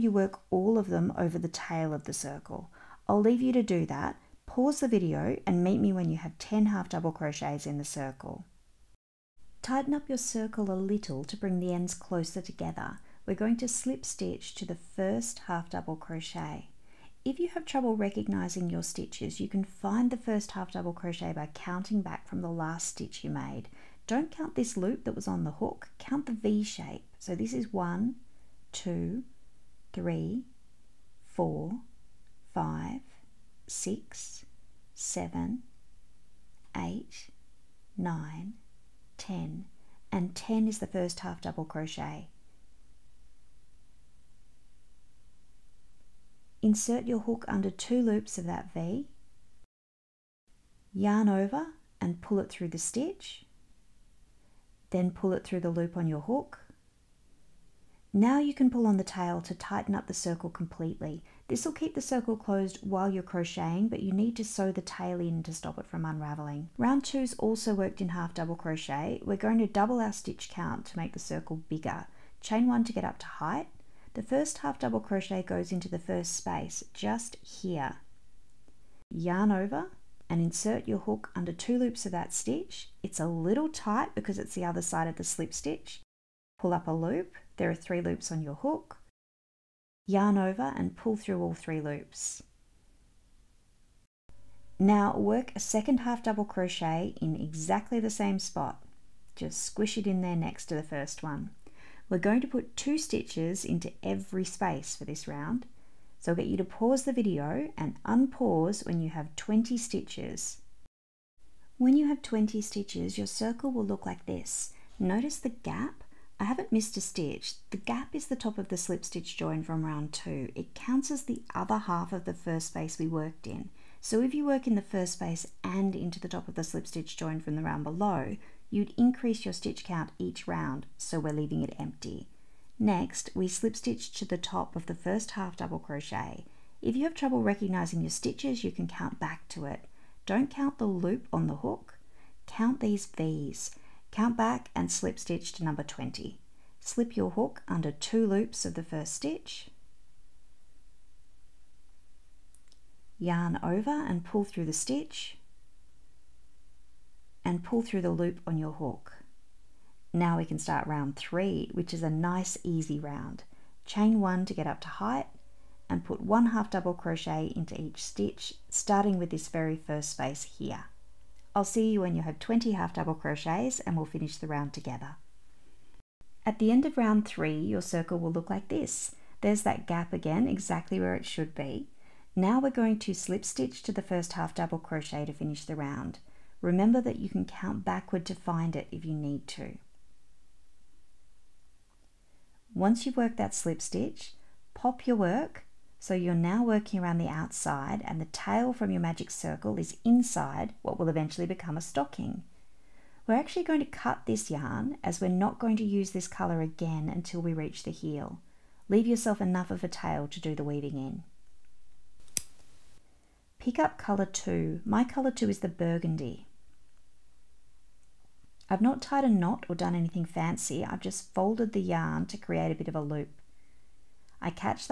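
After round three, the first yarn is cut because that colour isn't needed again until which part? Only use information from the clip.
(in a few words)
the heel.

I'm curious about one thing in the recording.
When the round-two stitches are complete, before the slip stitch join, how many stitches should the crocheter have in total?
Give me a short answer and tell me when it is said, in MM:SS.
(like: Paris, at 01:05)
20, at 01:48.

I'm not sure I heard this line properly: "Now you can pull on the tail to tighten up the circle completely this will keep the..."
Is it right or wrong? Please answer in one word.
right.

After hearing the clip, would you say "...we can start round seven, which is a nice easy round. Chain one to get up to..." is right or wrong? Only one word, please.
wrong.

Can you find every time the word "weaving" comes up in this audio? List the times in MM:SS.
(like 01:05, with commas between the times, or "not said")
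03:30.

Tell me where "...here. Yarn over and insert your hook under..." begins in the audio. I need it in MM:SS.
01:17.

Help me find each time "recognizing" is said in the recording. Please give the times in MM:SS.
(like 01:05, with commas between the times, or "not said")
00:17, 02:17.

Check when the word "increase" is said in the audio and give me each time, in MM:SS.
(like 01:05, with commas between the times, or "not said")
02:08.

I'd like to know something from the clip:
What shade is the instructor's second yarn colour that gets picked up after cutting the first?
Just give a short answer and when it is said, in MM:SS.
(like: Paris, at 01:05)
burgundy, at 03:35.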